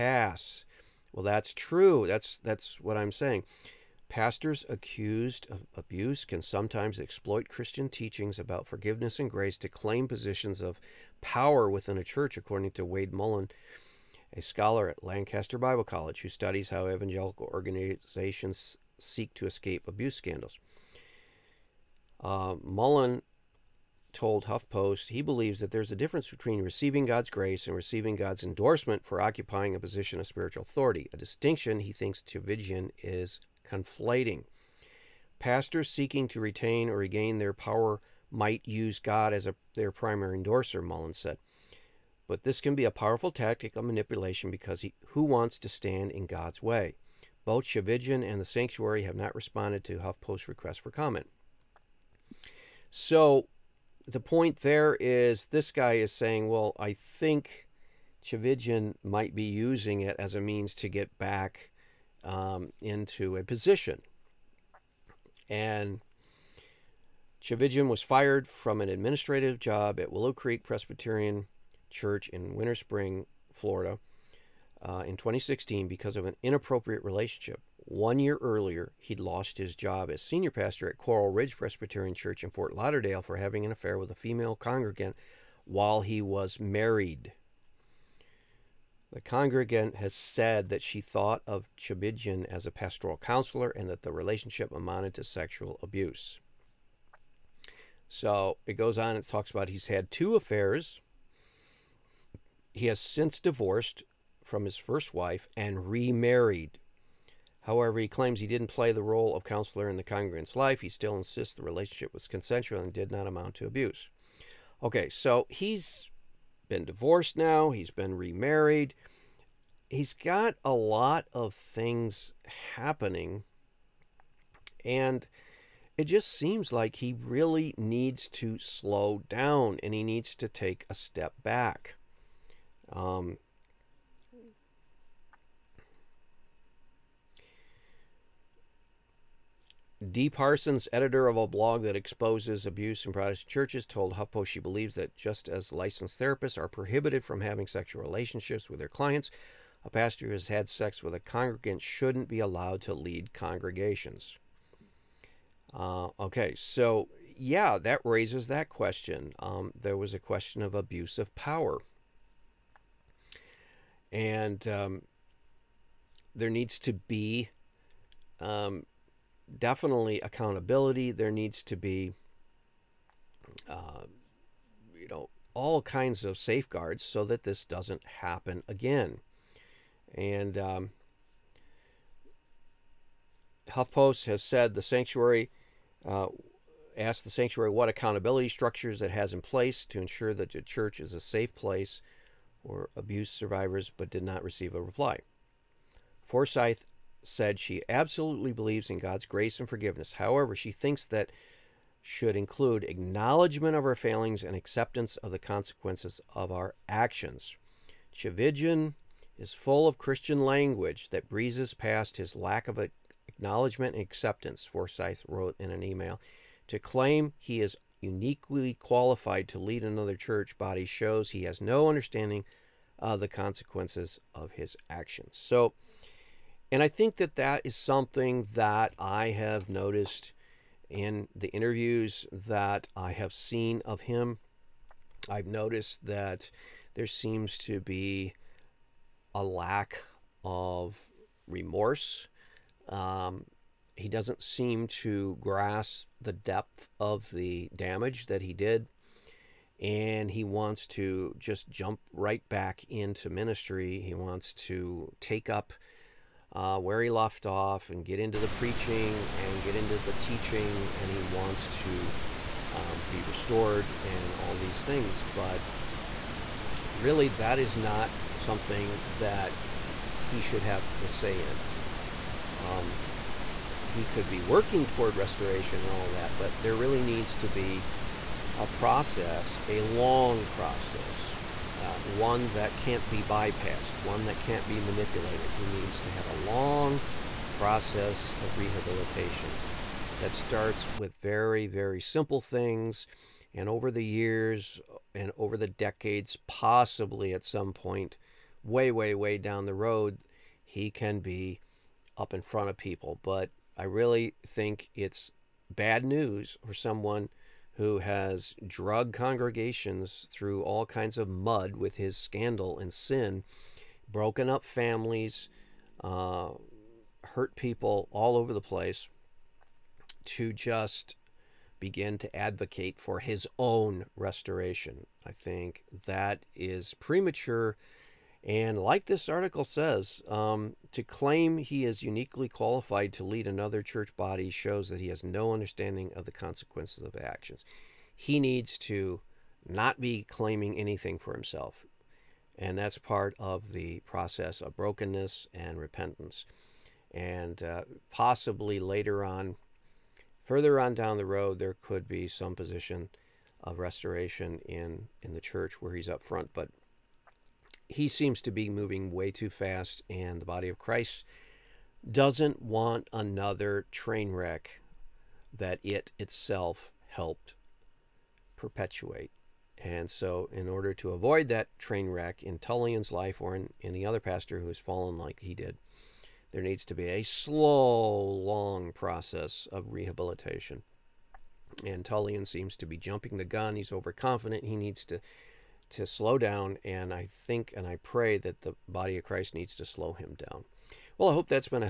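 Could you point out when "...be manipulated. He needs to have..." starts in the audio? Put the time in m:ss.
4:44.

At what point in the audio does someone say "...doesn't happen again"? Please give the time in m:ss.
2:57.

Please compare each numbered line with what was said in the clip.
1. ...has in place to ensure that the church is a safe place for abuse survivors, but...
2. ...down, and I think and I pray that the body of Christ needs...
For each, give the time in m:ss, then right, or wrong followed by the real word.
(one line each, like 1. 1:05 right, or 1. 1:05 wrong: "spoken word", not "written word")
1. 3:09 right
2. 6:26 right.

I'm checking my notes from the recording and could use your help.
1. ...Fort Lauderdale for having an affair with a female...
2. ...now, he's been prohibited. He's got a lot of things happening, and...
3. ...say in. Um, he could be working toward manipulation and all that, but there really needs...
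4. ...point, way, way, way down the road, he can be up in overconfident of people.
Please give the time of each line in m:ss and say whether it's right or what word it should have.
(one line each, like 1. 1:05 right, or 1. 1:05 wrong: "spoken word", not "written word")
1. 1:22 right
2. 1:57 wrong: "remarried", not "prohibited"
3. 4:31 wrong: "restoration", not "manipulation"
4. 4:57 wrong: "front", not "overconfident".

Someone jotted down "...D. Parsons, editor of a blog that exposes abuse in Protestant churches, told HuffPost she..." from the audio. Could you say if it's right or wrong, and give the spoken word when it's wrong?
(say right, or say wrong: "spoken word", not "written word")
right.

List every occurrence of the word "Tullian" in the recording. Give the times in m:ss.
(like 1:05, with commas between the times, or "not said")
6:12, 6:22.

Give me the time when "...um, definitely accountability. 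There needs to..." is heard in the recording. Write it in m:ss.
2:48.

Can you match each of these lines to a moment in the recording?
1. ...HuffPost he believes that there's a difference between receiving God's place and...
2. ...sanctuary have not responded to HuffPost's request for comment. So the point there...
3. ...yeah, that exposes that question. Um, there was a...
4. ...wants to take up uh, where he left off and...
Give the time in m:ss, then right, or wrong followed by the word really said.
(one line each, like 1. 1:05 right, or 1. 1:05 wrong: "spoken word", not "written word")
1. 0:24 wrong: "grace", not "place"
2. 0:48 right
3. 2:37 wrong: "raises", not "exposes"
4. 4:14 right.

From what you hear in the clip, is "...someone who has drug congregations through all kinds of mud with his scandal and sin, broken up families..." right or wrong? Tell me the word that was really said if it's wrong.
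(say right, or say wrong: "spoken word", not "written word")
right.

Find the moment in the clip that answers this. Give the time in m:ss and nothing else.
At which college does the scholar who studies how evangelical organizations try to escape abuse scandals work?
0:15.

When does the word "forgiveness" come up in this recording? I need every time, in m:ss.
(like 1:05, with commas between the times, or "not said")
0:08, 3:19.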